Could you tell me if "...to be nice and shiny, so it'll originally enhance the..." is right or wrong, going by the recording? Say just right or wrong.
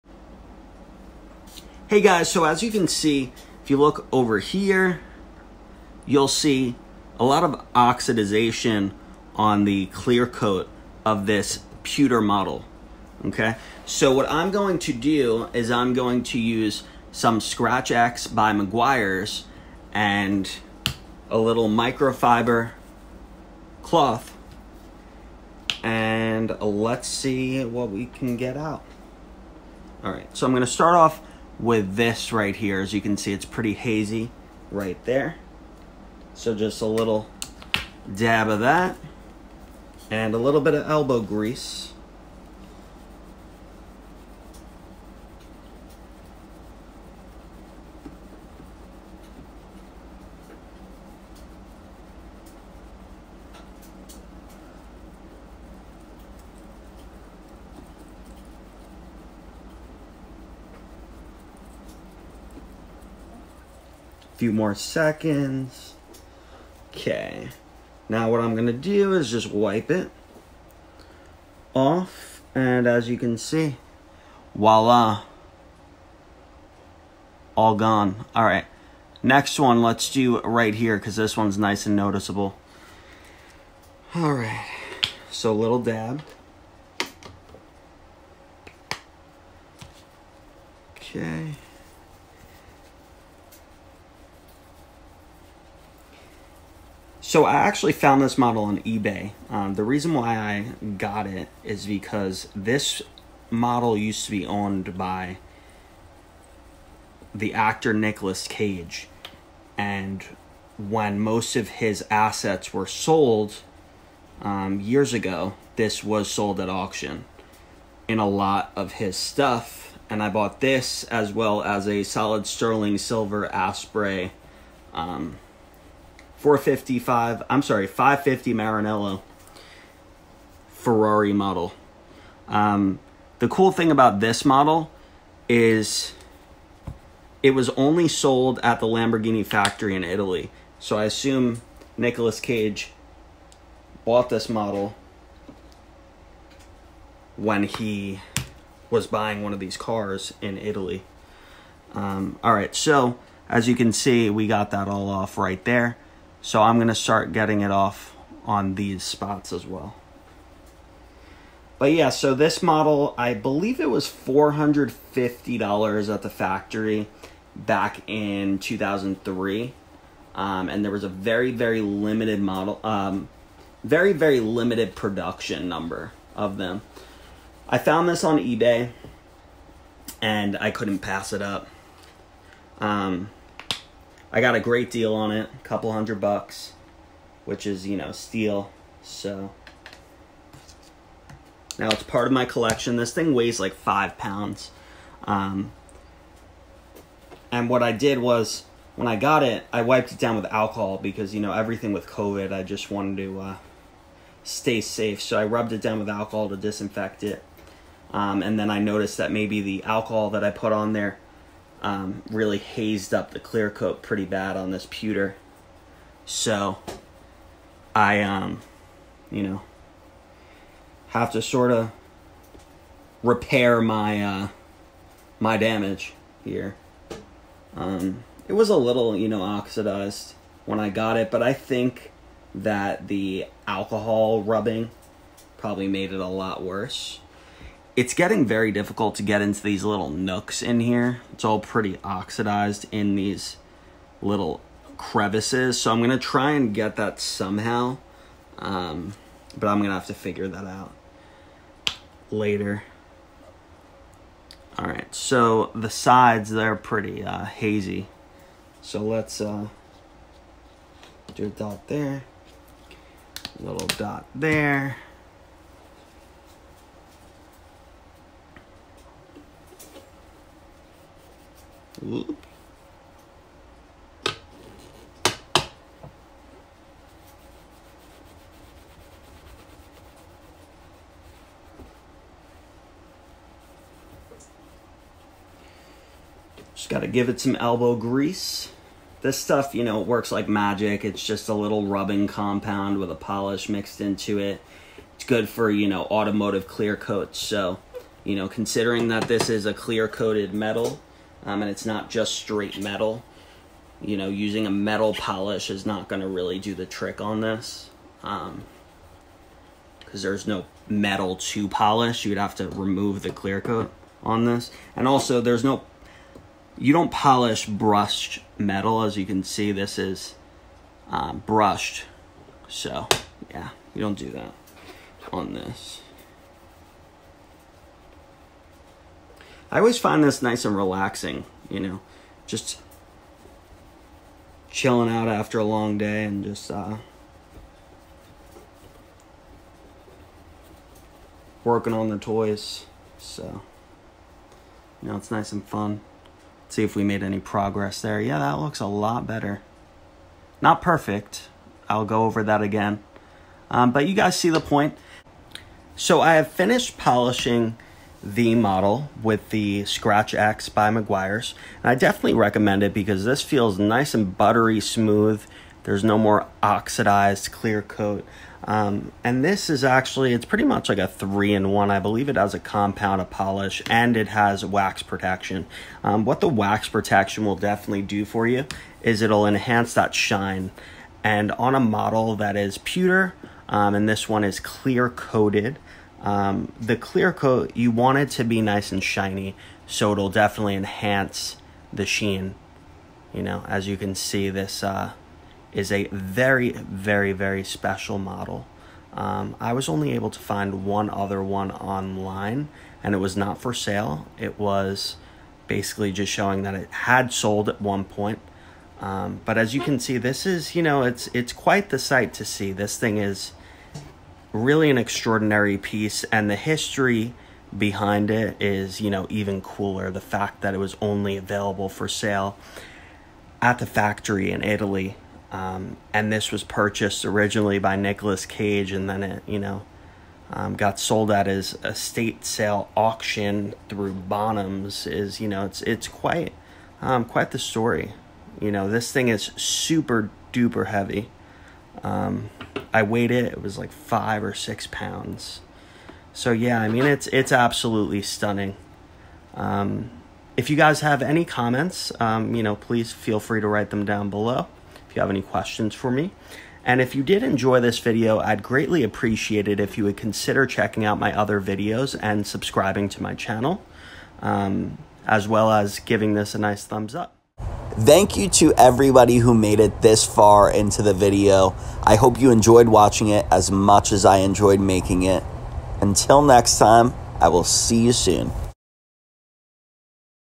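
wrong.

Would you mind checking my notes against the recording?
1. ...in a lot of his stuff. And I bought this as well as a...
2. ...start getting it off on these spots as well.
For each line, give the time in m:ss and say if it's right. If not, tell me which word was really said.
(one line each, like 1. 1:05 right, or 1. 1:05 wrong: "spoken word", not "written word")
1. 1:58 right
2. 2:36 right.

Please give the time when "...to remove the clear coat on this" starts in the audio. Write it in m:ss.
5:12.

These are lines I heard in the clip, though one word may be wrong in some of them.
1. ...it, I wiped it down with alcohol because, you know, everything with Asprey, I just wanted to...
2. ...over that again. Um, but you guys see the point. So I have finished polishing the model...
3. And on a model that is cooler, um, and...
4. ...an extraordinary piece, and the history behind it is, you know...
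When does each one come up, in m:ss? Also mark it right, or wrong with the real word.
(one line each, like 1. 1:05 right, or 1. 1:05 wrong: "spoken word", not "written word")
1. 3:19 wrong: "COVID", not "Asprey"
2. 5:52 right
3. 6:21 wrong: "pewter", not "cooler"
4. 6:54 right.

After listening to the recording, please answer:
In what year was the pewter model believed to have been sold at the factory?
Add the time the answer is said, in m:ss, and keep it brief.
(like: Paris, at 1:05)
2003, at 2:48.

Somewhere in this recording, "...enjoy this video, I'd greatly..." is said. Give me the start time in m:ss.
7:37.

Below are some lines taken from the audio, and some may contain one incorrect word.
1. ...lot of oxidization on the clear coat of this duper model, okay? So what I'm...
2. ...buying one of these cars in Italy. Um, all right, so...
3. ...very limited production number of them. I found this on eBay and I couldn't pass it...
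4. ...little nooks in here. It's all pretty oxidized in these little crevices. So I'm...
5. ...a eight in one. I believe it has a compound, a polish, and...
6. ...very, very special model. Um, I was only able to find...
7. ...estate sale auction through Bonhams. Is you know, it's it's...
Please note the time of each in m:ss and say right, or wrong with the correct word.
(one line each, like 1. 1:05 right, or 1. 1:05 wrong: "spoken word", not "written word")
1. 0:07 wrong: "pewter", not "duper"
2. 2:29 right
3. 2:54 right
4. 3:59 right
5. 6:10 wrong: "three", not "eight"
6. 6:36 right
7. 7:11 right.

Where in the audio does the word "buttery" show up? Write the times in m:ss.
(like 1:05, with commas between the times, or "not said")
6:04.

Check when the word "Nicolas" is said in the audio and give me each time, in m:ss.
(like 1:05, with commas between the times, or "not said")
1:47, 2:21, 7:07.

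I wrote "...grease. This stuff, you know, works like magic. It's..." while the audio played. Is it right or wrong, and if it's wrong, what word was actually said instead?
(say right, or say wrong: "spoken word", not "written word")
right.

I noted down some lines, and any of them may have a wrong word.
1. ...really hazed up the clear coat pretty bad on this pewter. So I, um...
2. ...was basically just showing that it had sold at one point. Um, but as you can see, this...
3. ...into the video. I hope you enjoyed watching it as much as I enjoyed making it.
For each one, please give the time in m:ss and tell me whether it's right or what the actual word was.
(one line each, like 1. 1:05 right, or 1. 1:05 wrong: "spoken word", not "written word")
1. 3:32 right
2. 6:44 right
3. 7:50 right.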